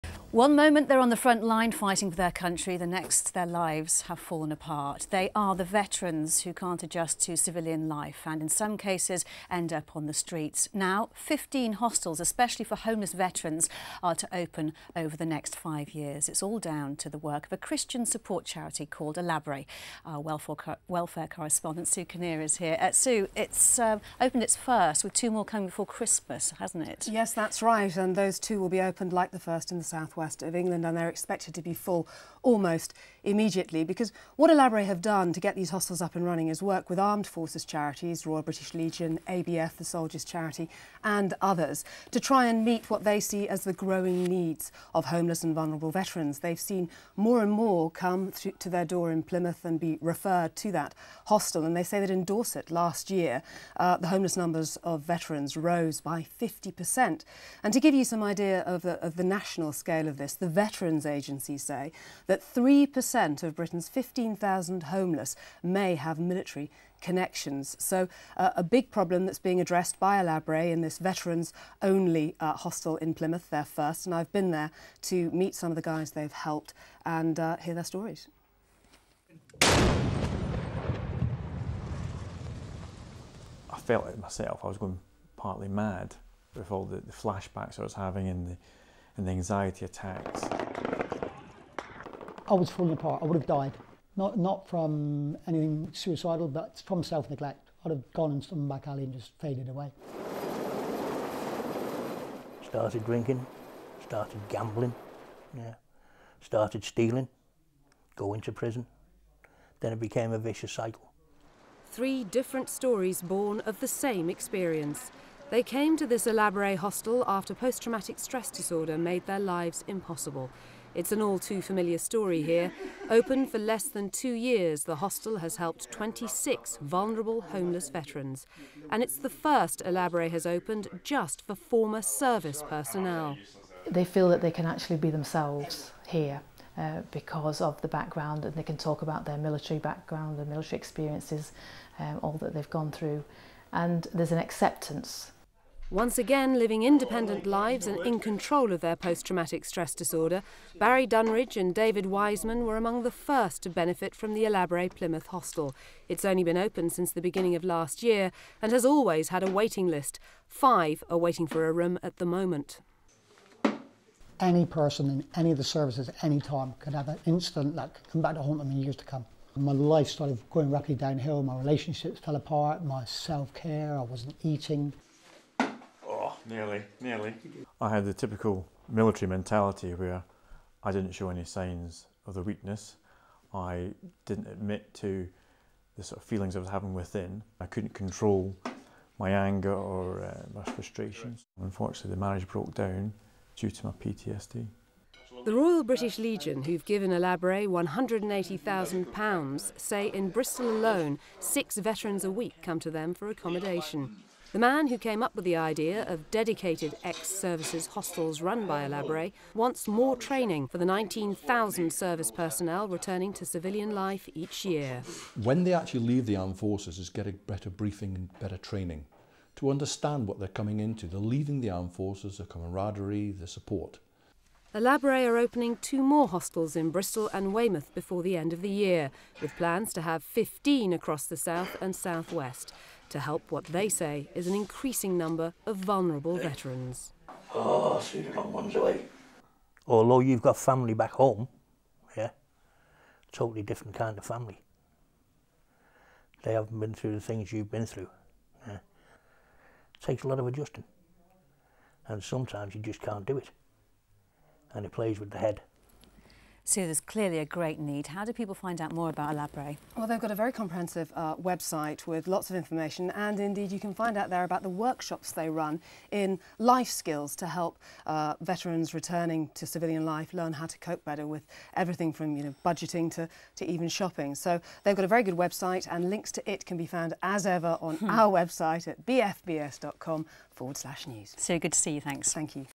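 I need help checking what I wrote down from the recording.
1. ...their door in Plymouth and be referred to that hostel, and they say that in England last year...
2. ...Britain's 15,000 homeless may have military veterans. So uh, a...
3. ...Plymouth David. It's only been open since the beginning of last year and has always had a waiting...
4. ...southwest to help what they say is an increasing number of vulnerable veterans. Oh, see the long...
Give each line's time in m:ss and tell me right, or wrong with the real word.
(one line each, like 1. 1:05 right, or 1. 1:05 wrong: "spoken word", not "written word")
1. 0:48 wrong: "Dorset", not "England"
2. 1:03 wrong: "connections", not "veterans"
3. 2:34 wrong: "Hostel", not "David"
4. 3:51 right.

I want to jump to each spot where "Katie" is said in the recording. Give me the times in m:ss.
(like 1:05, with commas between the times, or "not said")
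not said.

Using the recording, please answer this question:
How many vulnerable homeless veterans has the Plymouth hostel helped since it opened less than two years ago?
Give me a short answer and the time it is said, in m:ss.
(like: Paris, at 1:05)
26, at 2:05.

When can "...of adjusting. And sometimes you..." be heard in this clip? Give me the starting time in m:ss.
4:10.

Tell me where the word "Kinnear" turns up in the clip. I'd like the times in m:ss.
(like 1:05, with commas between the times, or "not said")
0:22.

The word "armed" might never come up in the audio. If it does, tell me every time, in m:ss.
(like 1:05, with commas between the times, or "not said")
0:36, 3:36, 3:41.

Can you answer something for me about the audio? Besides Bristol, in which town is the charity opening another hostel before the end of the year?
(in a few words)
Weymouth.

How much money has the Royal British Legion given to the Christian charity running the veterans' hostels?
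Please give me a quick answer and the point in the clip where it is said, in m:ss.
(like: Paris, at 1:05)
£180,000, at 3:17.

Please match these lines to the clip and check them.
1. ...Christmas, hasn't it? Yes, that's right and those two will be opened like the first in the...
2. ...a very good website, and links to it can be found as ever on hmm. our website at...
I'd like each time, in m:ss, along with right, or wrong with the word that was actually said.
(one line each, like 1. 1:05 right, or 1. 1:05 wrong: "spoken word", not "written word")
1. 0:25 right
2. 4:35 right.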